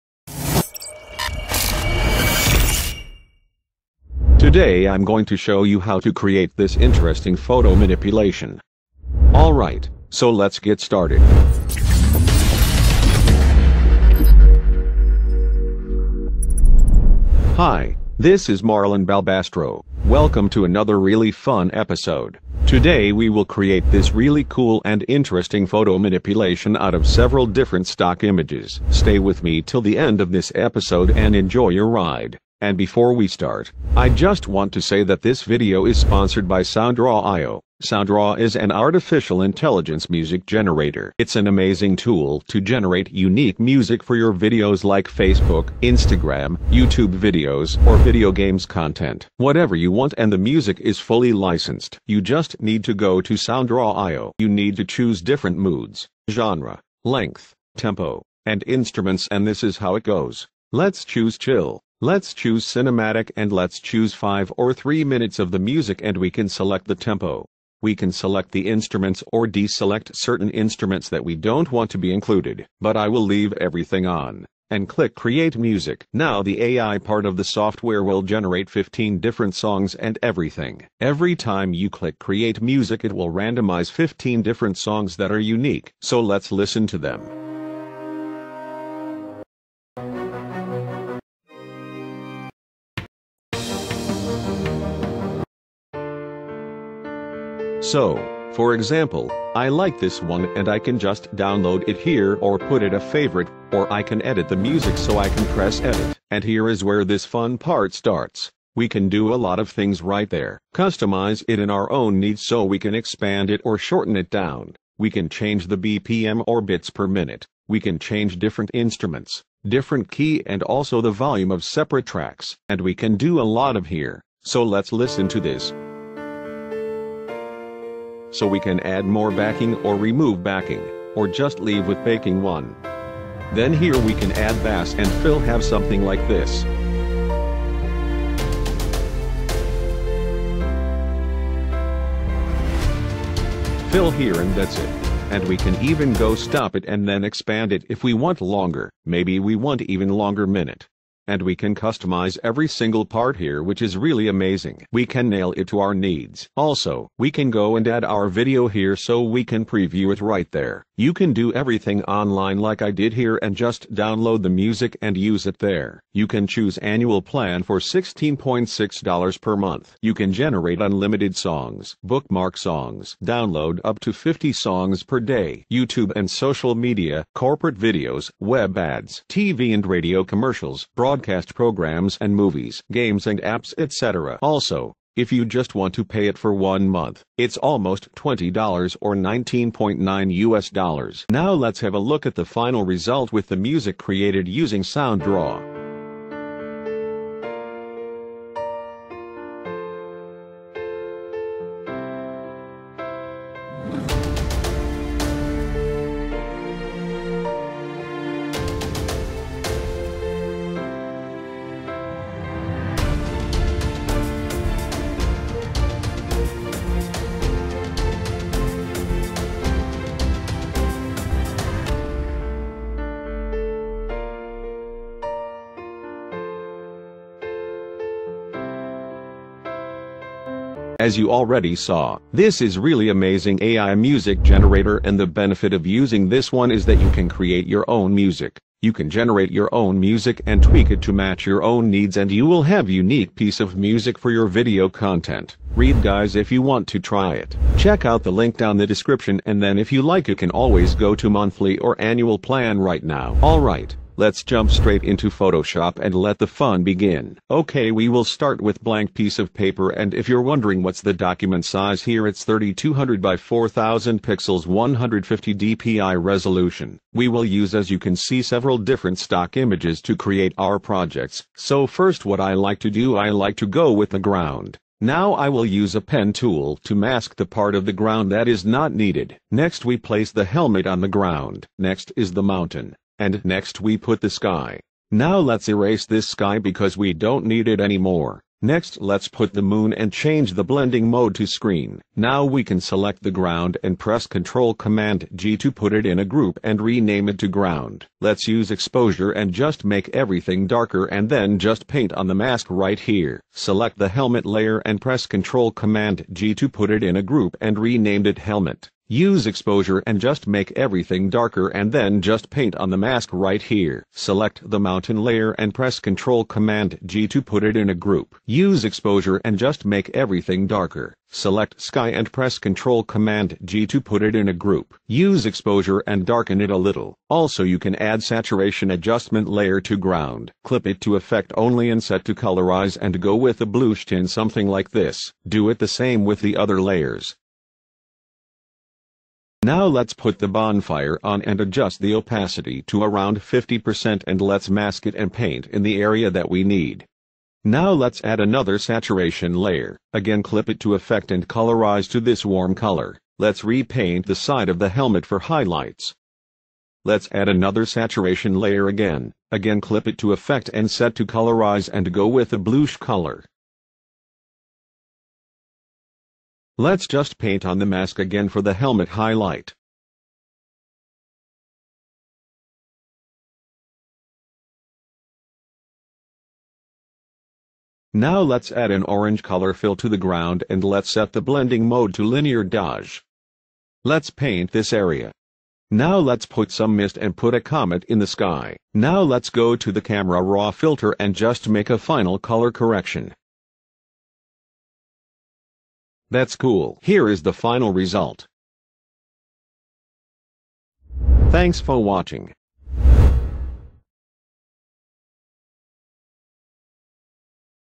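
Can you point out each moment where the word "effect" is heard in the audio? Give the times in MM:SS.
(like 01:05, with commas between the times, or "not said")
05:31, 05:50, 06:00.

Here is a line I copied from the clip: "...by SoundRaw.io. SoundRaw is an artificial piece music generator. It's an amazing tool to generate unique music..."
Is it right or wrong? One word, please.
wrong.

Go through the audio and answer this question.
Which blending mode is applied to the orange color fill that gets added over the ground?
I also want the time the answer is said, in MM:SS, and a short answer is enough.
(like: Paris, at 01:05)
Linear dodge, at 06:22.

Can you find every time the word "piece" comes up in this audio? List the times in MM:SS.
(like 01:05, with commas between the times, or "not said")
04:03, 04:19.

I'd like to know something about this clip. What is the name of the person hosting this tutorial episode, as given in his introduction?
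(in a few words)
Marlon Balbastro.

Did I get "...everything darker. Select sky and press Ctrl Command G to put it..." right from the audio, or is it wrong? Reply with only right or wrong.
right.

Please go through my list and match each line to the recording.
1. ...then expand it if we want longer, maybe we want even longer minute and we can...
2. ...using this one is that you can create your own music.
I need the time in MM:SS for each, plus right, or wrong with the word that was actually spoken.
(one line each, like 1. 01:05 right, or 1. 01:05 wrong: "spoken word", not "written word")
1. 02:27 right
2. 03:55 right.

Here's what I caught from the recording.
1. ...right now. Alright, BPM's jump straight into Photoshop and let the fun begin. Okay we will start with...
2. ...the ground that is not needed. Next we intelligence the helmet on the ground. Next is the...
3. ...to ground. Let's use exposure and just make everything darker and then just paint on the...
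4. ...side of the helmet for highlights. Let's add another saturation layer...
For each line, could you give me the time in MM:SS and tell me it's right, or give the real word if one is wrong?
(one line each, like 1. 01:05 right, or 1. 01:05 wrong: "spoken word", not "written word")
1. 04:12 wrong: "Let", not "BPM"
2. 04:37 wrong: "place", not "intelligence"
3. 04:57 right
4. 05:54 right.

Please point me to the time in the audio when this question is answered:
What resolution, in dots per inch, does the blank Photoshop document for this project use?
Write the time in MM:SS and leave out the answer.
04:24.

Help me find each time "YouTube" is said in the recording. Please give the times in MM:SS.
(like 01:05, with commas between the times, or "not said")
00:46, 02:55.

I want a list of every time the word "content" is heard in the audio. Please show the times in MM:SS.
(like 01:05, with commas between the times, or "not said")
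00:48, 04:04.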